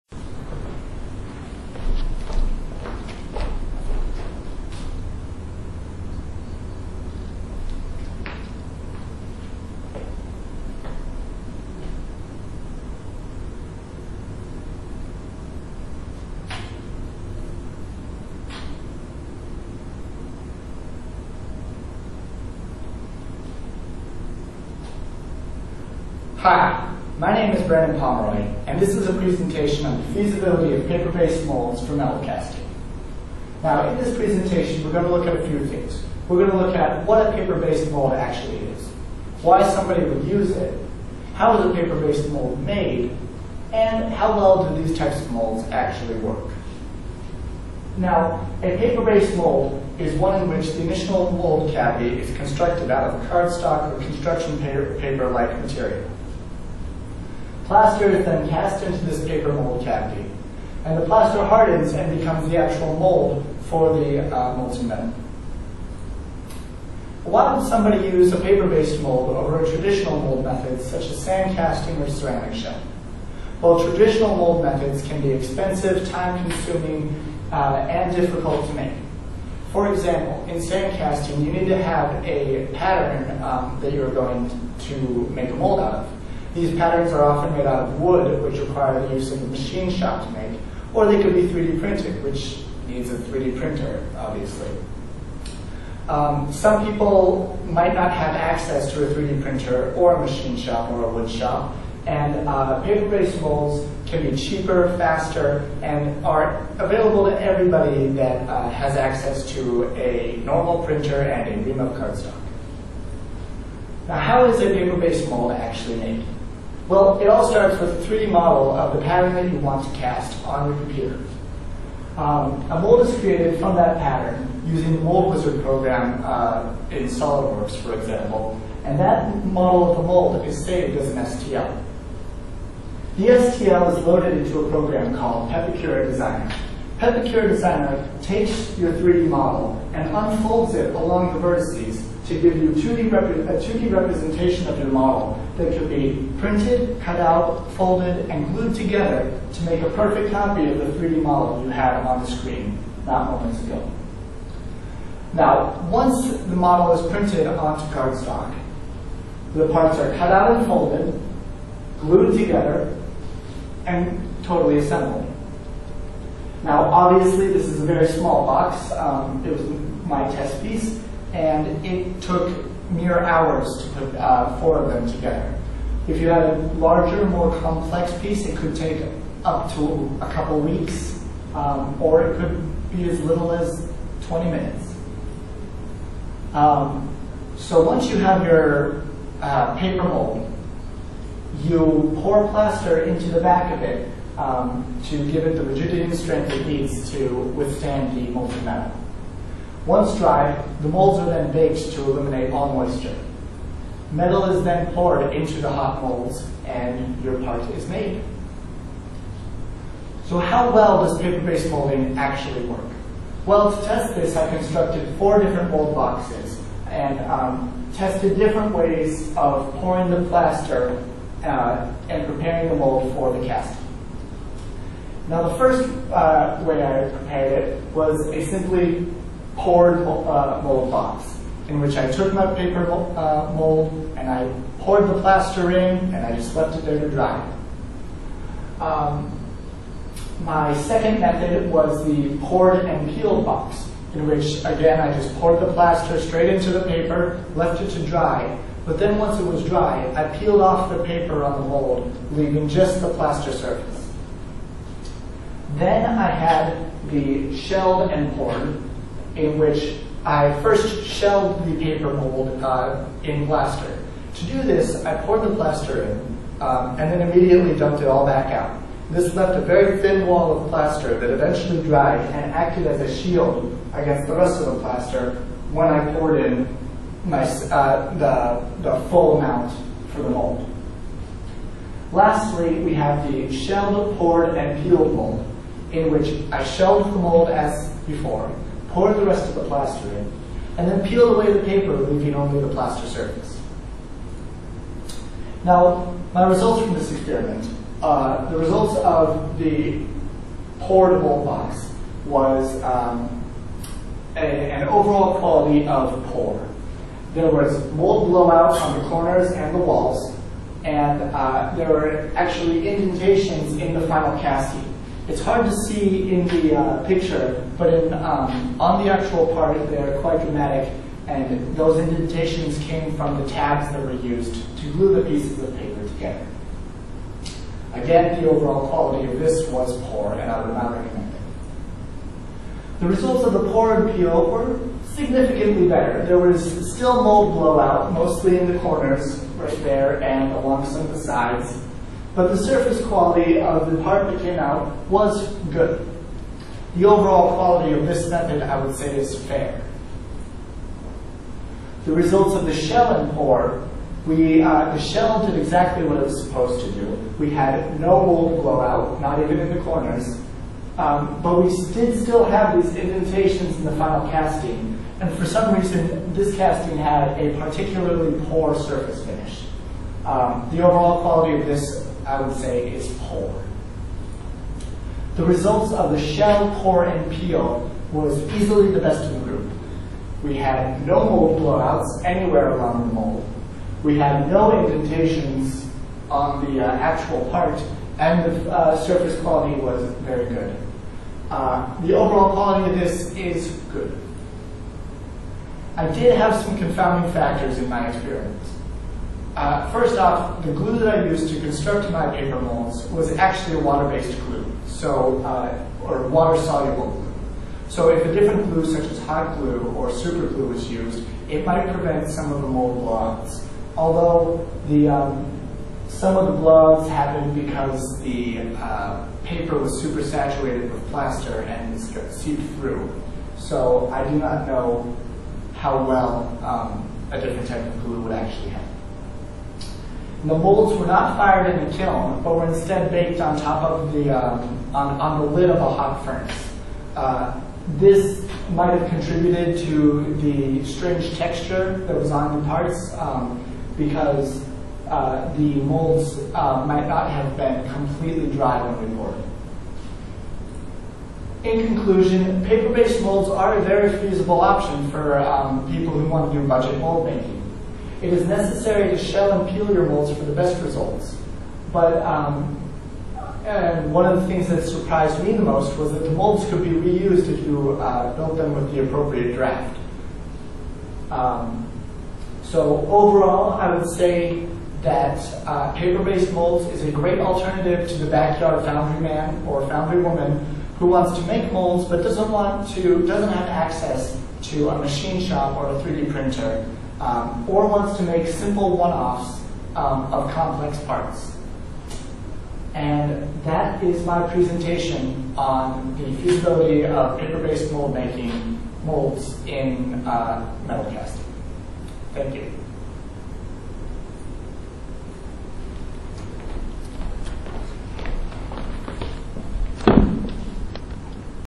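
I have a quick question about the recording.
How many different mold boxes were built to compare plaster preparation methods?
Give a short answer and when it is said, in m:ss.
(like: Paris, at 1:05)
4, at 3:35.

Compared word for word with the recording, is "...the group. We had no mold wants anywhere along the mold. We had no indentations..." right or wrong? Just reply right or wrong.
wrong.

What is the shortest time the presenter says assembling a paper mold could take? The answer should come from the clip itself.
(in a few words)
20 minutes.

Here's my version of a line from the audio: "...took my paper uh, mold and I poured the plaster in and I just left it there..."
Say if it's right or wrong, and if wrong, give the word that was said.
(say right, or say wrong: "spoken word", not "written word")
right.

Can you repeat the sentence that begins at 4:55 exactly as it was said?
Now, my results from this experiment, uh, the results of the poured mold box was um, a, an overall quality of pour.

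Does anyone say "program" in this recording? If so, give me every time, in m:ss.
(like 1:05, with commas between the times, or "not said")
2:05, 2:14.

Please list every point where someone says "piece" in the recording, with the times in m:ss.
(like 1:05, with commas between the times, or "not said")
2:50, 2:58, 5:25.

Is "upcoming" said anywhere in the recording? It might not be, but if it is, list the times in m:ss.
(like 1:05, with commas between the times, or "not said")
not said.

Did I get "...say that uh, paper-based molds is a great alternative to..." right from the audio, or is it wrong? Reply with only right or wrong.
right.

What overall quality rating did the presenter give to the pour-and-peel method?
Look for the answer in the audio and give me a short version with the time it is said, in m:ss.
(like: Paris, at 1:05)
fair, at 5:49.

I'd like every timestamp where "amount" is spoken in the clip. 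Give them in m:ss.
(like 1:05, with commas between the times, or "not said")
4:39.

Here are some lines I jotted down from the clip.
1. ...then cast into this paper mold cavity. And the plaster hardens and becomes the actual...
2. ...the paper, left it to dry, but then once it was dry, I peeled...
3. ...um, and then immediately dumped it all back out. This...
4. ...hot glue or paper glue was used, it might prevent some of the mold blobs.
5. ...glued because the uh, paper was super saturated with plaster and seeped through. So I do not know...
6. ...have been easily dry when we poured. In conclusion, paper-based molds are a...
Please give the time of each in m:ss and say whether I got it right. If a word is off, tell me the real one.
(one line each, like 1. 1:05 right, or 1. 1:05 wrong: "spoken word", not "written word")
1. 0:58 right
2. 4:06 right
3. 4:26 right
4. 6:49 wrong: "super", not "paper"
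5. 6:57 wrong: "happened", not "glued"
6. 7:27 wrong: "completely", not "easily".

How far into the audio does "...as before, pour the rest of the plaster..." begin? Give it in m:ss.
4:47.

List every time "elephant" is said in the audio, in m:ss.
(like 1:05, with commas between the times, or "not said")
not said.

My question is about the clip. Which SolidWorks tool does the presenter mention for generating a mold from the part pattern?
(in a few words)
Mold Wizard.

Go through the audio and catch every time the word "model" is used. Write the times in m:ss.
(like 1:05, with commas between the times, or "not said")
1:58, 2:09, 2:19, 2:24, 2:31, 2:36.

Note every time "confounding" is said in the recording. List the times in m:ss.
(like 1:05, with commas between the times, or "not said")
6:36.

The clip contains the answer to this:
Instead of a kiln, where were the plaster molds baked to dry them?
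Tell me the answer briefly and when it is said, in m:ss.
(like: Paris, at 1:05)
lid of a hot furnace, at 7:15.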